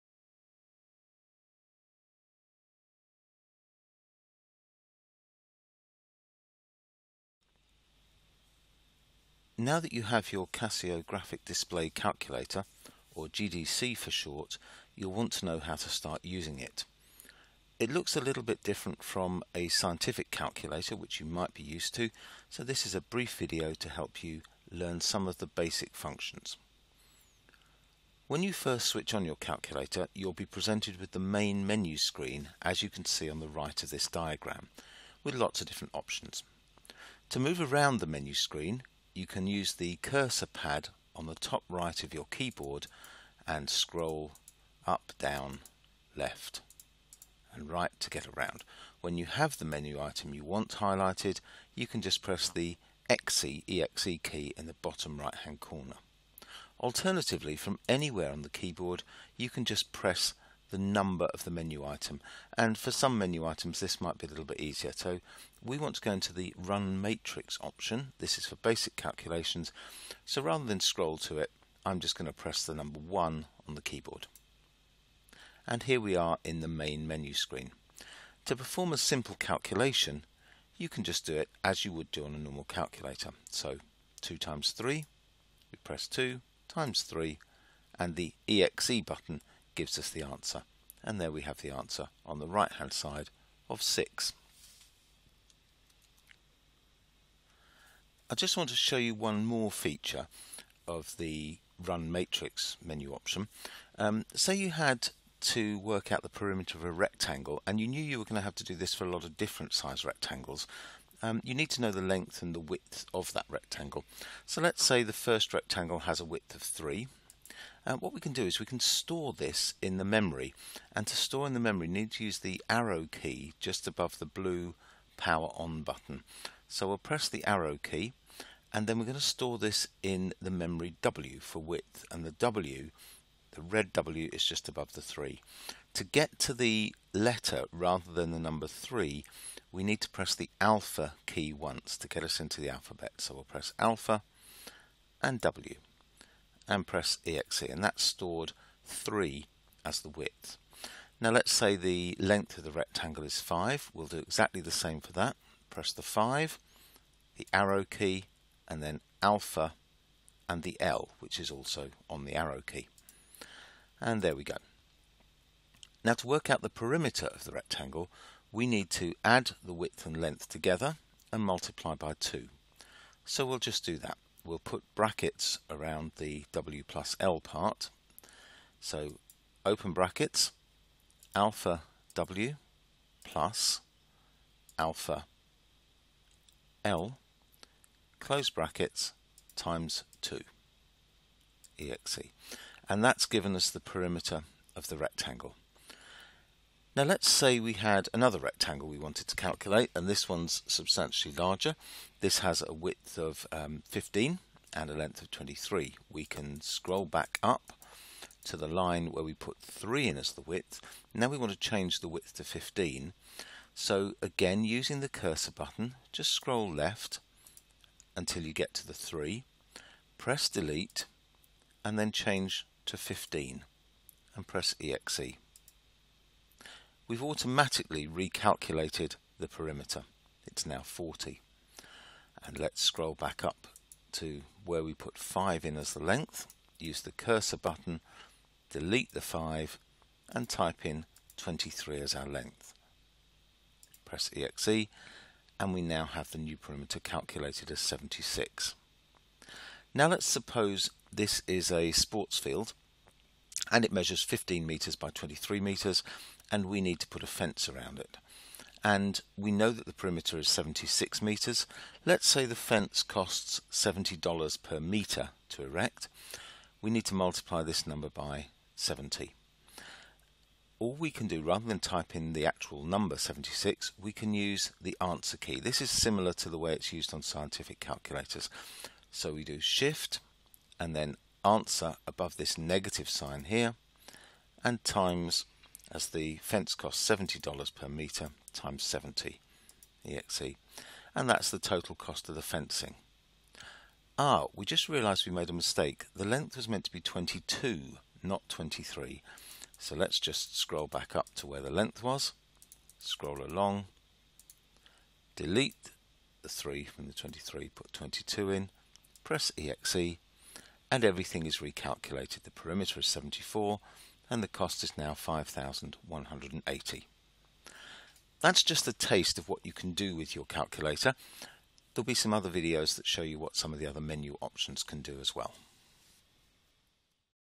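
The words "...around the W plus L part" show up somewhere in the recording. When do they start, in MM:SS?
02:55.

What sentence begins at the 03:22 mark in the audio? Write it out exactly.
This has a width of um, 15 and a length of 23.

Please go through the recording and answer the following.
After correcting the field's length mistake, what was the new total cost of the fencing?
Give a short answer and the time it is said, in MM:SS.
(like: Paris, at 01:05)
5,180, at 05:15.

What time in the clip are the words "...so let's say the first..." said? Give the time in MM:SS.
01:54.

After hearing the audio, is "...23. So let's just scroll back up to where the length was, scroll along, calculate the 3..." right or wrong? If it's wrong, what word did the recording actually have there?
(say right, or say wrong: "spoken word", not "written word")
wrong: "delete", not "calculate".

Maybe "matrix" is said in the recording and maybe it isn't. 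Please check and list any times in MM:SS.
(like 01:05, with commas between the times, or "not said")
01:06, 01:42.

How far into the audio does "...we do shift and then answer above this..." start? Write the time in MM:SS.
04:39.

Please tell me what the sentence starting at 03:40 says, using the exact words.
Press delete and then change to 15 and press exe we've automatically recalculated the perimeter.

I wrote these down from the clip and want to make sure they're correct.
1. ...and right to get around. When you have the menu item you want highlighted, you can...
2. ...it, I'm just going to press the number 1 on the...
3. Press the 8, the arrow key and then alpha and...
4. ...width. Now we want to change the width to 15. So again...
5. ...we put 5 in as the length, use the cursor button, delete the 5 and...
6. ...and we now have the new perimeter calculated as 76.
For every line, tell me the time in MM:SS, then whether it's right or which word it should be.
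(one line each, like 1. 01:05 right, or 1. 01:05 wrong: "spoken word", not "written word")
1. 00:47 right
2. 01:11 right
3. 02:35 wrong: "5", not "8"
4. 03:30 right
5. 03:54 right
6. 04:05 right.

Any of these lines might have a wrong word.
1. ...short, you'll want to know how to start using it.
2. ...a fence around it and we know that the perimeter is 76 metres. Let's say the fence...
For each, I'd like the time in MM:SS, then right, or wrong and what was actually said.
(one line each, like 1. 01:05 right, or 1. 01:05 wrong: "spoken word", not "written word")
1. 00:14 right
2. 04:17 right.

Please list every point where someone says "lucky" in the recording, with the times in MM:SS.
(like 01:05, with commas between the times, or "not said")
not said.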